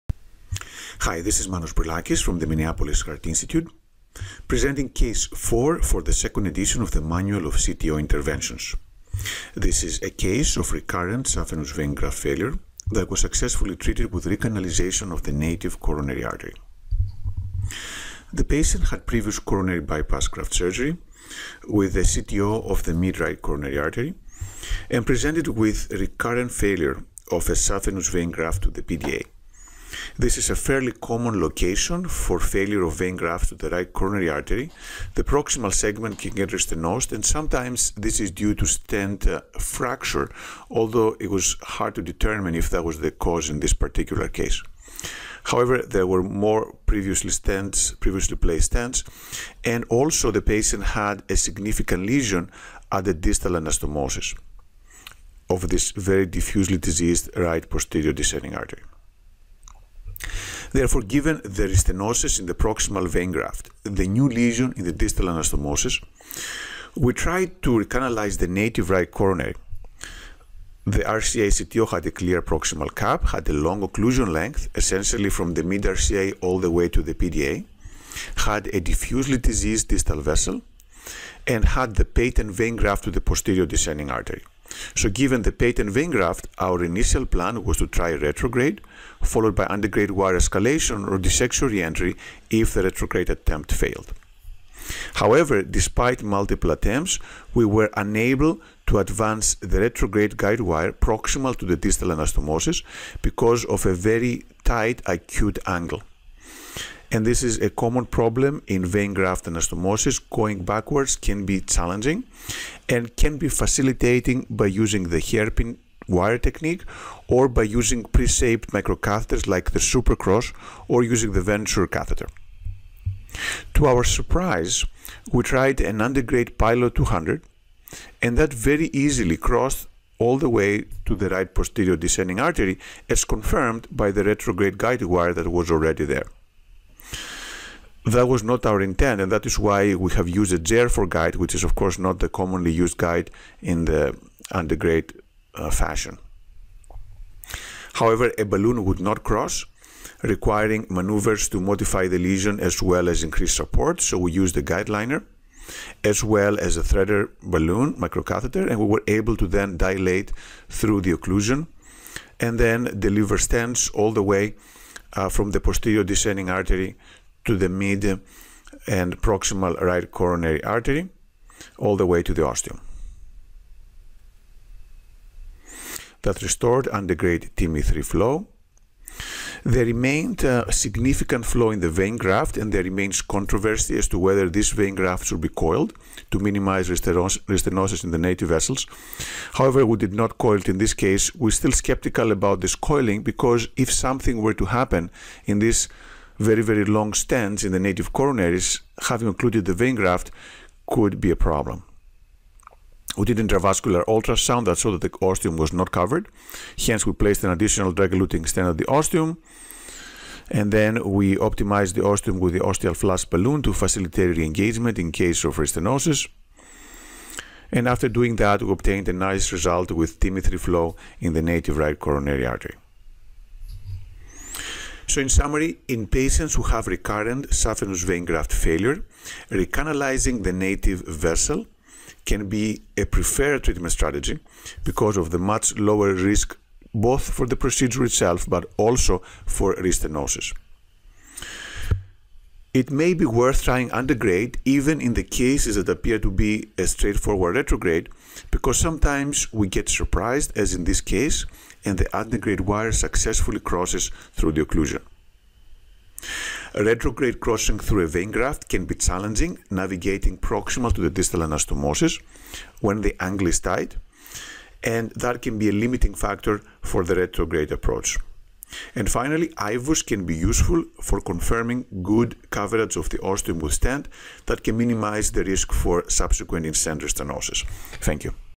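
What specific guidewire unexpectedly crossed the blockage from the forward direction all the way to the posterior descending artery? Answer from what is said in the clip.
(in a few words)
Pilot 200.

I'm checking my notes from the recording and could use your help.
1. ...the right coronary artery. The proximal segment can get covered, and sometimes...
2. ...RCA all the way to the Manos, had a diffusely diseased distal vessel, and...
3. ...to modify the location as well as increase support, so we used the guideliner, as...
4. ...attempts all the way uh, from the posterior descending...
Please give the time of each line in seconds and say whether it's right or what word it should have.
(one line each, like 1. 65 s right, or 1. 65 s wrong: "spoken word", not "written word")
1. 33 s wrong: "restenosed", not "covered"
2. 75 s wrong: "PDA", not "Manos"
3. 151 s wrong: "lesion", not "location"
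4. 163 s wrong: "stents", not "attempts".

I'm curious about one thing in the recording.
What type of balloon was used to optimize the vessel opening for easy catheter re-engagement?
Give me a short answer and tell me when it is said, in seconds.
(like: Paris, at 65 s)
ostial flush balloon, at 212 s.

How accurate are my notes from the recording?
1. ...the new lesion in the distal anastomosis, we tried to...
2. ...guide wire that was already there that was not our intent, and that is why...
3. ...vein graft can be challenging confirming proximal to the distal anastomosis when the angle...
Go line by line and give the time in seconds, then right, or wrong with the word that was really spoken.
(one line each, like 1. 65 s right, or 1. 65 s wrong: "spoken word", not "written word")
1. 63 s right
2. 134 s right
3. 258 s wrong: "navigating", not "confirming".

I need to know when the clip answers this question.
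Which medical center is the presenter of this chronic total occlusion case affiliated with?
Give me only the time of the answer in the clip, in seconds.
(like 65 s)
2 s.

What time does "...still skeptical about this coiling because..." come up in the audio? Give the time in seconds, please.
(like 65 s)
191 s.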